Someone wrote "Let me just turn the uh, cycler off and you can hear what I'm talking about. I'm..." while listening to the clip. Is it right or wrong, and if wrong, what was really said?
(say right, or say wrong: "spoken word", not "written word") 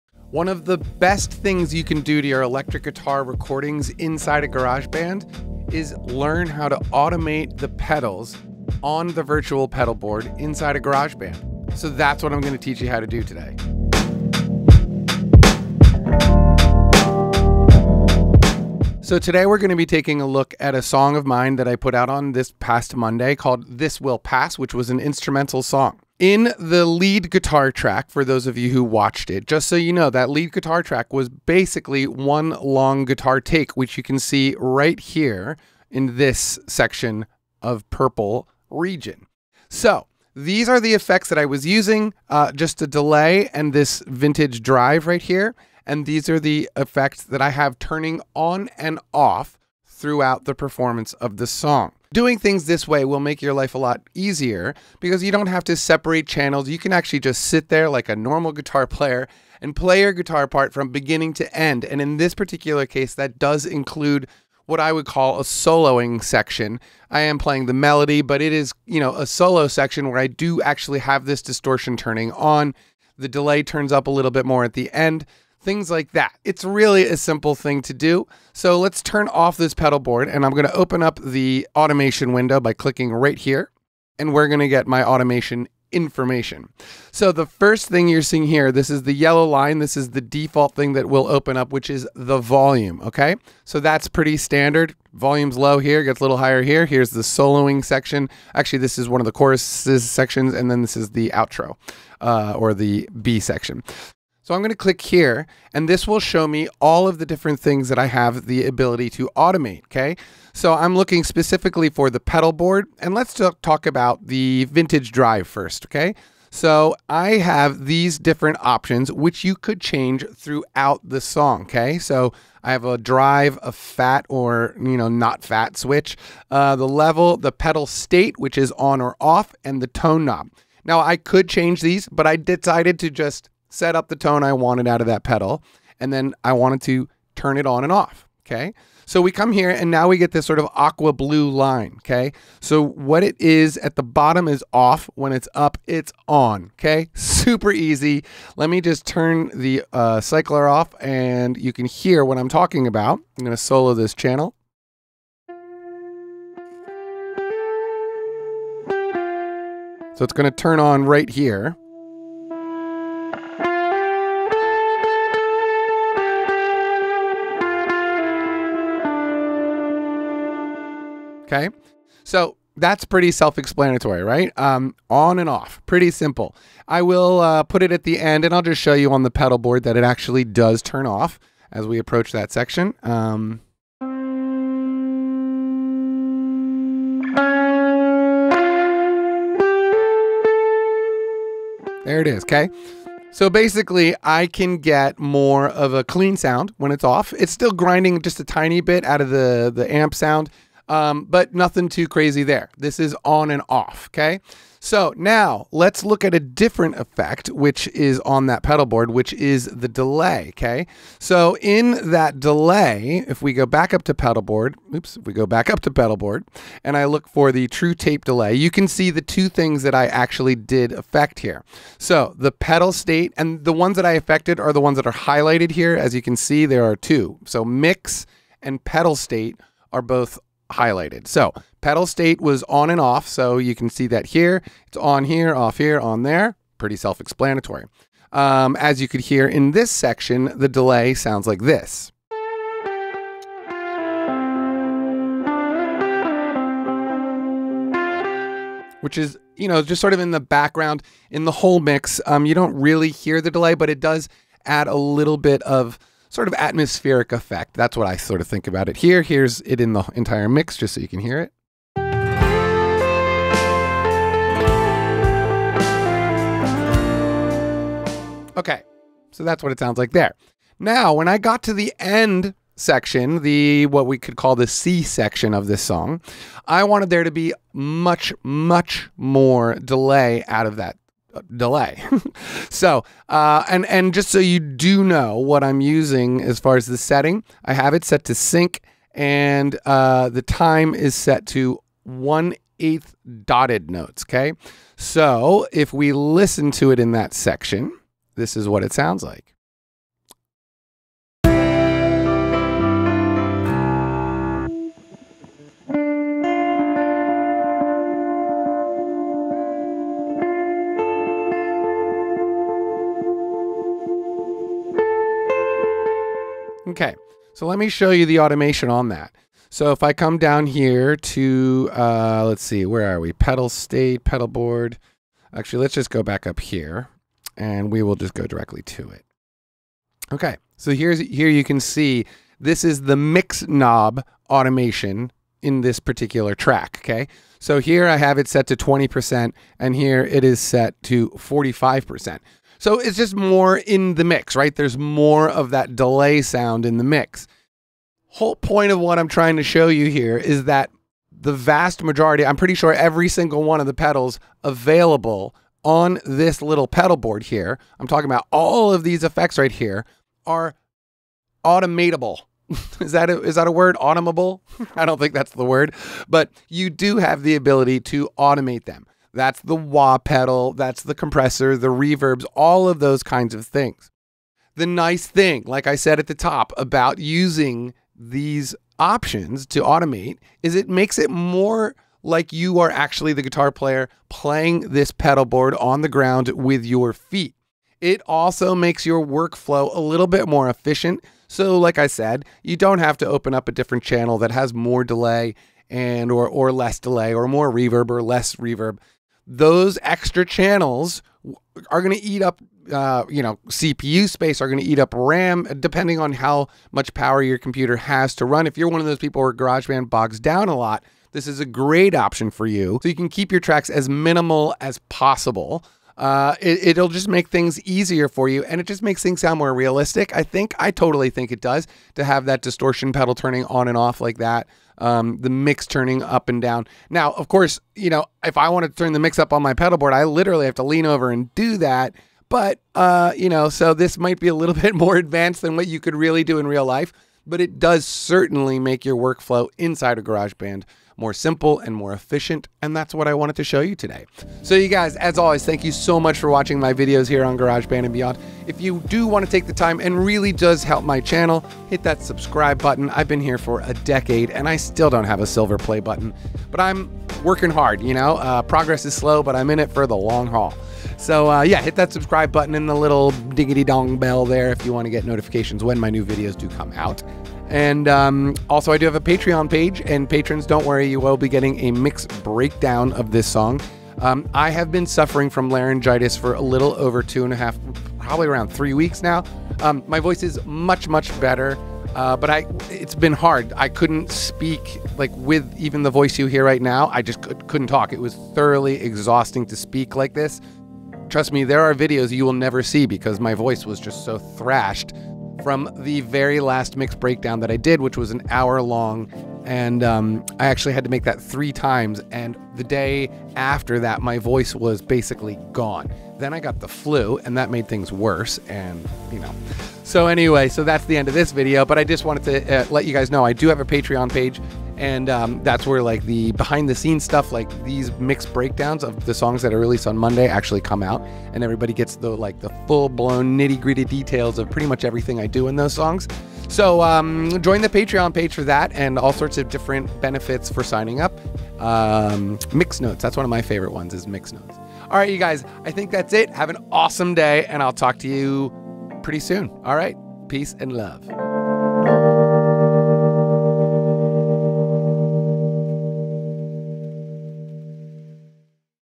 right.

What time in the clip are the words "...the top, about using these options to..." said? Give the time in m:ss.
6:16.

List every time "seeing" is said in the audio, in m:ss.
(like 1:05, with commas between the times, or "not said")
1:28.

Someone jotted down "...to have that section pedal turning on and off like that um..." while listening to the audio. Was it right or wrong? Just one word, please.
wrong.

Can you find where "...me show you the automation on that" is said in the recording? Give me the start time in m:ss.
5:17.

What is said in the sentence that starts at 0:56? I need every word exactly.
You can actually just sit there like a normal guitar player and play your guitar part from beginning to end.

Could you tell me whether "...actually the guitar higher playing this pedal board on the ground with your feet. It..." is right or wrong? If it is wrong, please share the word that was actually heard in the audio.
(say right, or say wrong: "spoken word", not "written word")
wrong: "player", not "higher".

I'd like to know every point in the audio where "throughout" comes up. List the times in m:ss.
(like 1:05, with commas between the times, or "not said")
0:49, 2:00.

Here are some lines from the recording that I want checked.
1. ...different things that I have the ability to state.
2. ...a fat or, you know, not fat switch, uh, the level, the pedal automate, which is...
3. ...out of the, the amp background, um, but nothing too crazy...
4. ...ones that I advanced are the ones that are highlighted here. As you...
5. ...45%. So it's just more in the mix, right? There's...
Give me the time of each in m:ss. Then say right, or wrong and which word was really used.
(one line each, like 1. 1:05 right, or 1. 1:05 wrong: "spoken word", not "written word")
1. 1:47 wrong: "automate", not "state"
2. 2:03 wrong: "state", not "automate"
3. 3:19 wrong: "sound", not "background"
4. 3:43 wrong: "affected", not "advanced"
5. 5:41 right.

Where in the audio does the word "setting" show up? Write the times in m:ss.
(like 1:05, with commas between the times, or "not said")
4:46.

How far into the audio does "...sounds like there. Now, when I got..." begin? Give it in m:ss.
4:29.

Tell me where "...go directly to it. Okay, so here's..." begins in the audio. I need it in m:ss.
5:28.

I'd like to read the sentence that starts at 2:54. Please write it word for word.
Um, on and off, pretty simple.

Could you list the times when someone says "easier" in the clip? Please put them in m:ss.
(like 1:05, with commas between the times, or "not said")
0:54, 6:57.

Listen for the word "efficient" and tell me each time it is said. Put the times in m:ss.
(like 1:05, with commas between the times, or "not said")
6:30, 7:22.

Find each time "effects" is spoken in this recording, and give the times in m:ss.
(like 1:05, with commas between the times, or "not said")
0:40, 0:46, 3:26, 4:17, 5:59.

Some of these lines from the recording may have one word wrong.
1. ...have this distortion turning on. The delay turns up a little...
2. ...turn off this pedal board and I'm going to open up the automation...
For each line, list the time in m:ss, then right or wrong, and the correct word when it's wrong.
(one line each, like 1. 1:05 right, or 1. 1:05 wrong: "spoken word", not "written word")
1. 1:10 right
2. 1:19 right.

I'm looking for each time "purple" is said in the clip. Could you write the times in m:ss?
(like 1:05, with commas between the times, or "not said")
0:37.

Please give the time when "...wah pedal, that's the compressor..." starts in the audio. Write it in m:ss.
6:09.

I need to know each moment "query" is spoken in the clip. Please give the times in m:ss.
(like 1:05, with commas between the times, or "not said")
not said.